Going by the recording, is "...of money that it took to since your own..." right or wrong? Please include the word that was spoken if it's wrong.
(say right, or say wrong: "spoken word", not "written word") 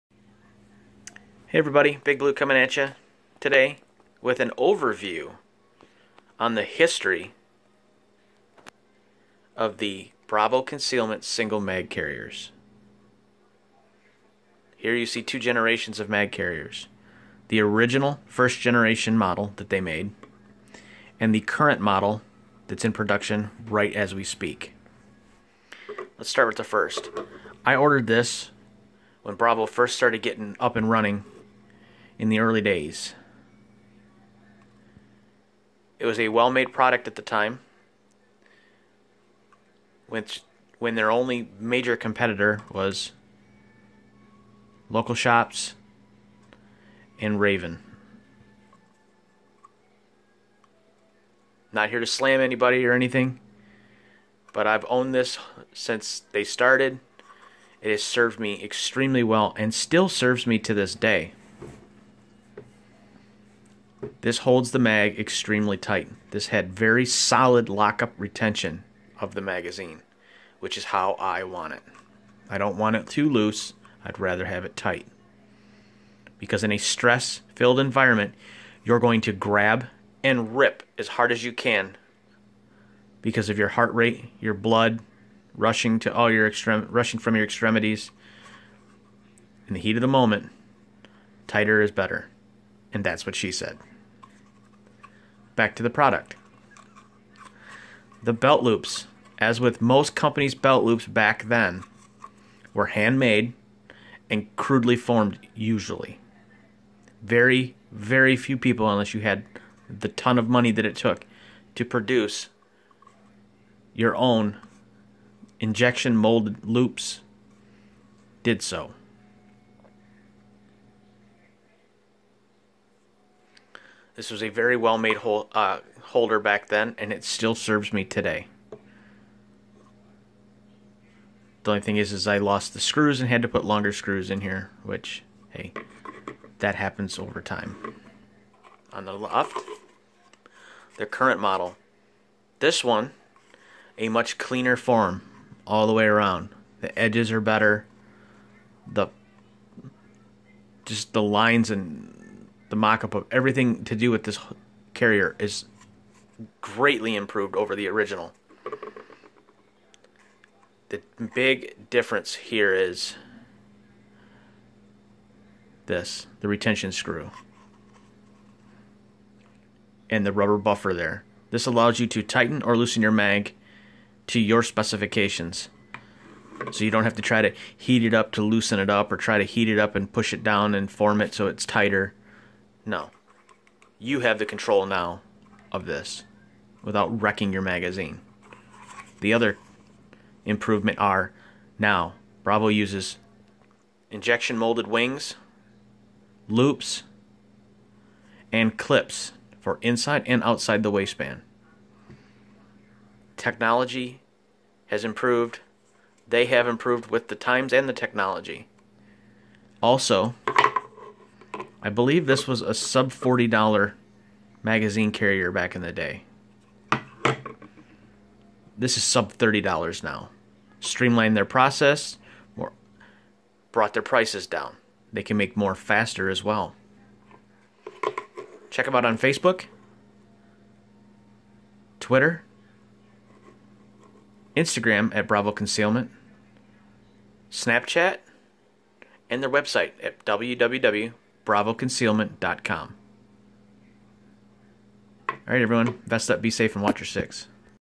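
wrong: "produce", not "since".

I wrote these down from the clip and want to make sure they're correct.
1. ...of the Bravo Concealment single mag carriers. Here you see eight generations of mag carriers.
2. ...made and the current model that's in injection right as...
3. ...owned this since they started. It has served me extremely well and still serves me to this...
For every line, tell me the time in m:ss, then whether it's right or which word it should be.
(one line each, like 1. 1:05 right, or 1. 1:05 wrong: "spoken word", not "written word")
1. 0:09 wrong: "two", not "eight"
2. 0:19 wrong: "production", not "injection"
3. 0:54 right.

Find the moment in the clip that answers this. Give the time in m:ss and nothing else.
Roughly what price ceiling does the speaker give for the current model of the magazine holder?
3:39.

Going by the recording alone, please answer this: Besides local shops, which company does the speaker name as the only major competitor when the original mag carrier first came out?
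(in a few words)
Raven.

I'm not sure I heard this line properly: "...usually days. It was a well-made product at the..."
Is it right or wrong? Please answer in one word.
wrong.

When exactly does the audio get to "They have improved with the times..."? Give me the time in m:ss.
3:26.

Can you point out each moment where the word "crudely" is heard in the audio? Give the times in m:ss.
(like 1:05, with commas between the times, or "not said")
1:44.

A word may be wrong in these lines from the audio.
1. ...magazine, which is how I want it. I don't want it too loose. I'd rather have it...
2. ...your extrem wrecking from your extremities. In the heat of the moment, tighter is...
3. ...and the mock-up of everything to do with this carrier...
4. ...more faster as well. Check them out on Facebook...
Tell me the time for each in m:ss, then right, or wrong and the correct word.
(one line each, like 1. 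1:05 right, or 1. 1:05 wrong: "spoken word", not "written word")
1. 1:09 right
2. 1:26 wrong: "rushing", not "wrecking"
3. 2:31 right
4. 3:45 right.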